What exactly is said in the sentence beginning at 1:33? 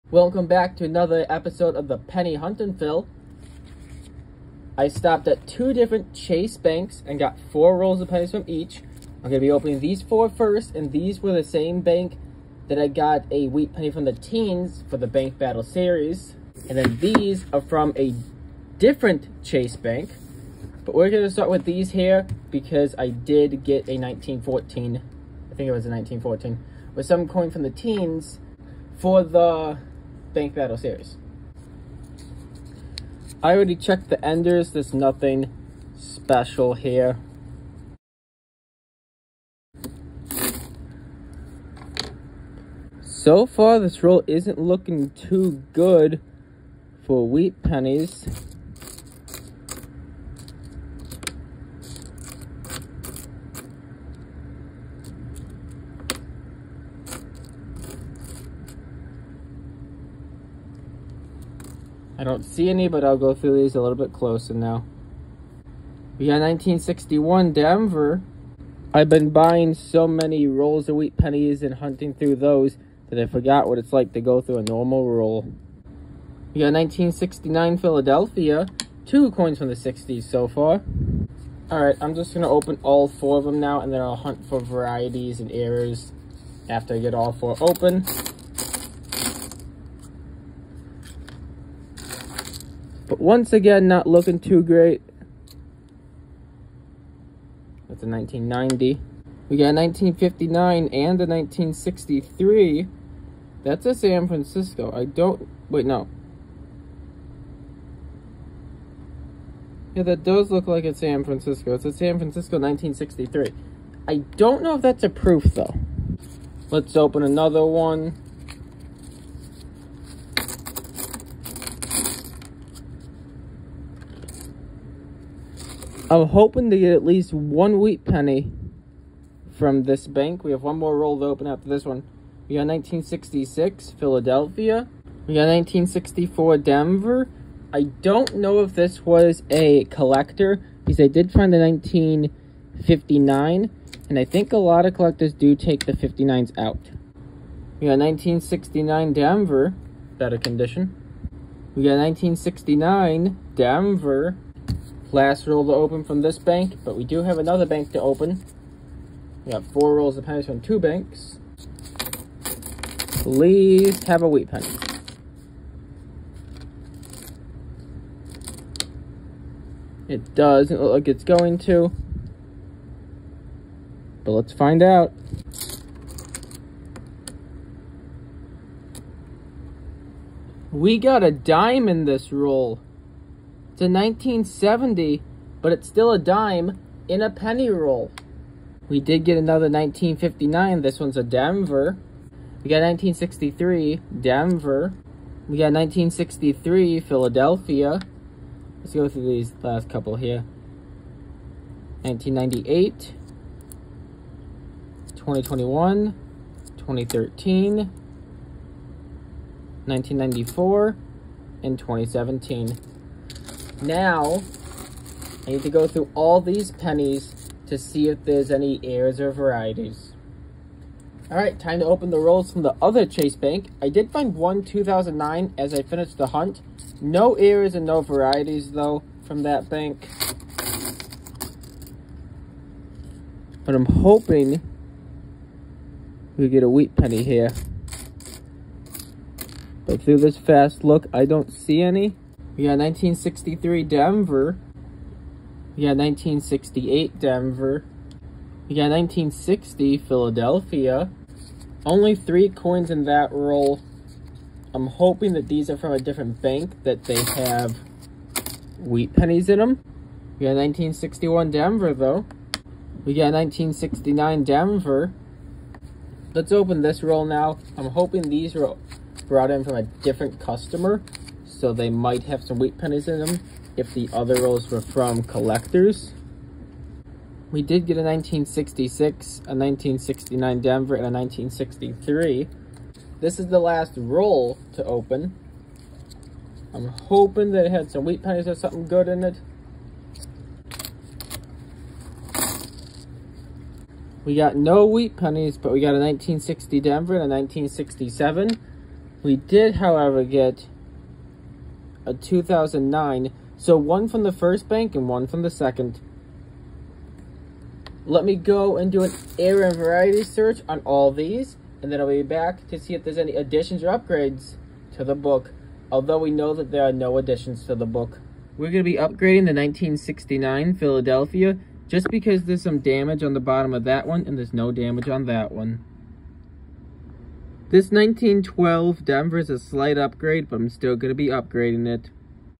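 Once again, not looking too great.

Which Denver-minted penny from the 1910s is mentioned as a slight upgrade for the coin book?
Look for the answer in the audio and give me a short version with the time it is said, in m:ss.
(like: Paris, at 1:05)
1912 Denver, at 5:27.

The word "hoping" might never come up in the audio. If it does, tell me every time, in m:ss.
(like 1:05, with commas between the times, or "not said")
2:06, 3:53, 4:14, 4:27, 4:46.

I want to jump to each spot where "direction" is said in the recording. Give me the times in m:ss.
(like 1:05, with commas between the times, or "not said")
not said.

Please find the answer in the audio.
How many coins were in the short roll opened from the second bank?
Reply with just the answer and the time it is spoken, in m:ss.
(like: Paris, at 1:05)
3, at 4:12.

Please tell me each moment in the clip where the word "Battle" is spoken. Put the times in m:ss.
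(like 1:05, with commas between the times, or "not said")
0:15, 0:30.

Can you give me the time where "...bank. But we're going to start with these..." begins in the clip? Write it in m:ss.
0:19.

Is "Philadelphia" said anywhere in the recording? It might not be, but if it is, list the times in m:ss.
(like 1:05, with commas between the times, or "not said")
1:17, 2:13, 3:16, 4:09, 5:20.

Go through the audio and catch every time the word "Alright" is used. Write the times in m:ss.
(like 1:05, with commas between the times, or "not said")
1:21, 3:41.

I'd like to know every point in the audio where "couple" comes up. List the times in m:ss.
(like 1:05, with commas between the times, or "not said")
3:19.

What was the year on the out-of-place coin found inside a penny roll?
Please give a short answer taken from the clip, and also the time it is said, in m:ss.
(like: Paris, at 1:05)
1970, at 3:03.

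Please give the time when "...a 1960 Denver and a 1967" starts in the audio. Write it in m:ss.
4:55.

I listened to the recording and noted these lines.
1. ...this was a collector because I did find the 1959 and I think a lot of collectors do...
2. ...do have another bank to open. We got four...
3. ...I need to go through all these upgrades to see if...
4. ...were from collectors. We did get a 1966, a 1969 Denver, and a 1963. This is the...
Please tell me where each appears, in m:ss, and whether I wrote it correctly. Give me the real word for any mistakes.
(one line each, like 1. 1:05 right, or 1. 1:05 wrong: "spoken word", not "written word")
1. 2:18 right
2. 2:37 right
3. 3:35 wrong: "pennies", not "upgrades"
4. 4:34 right.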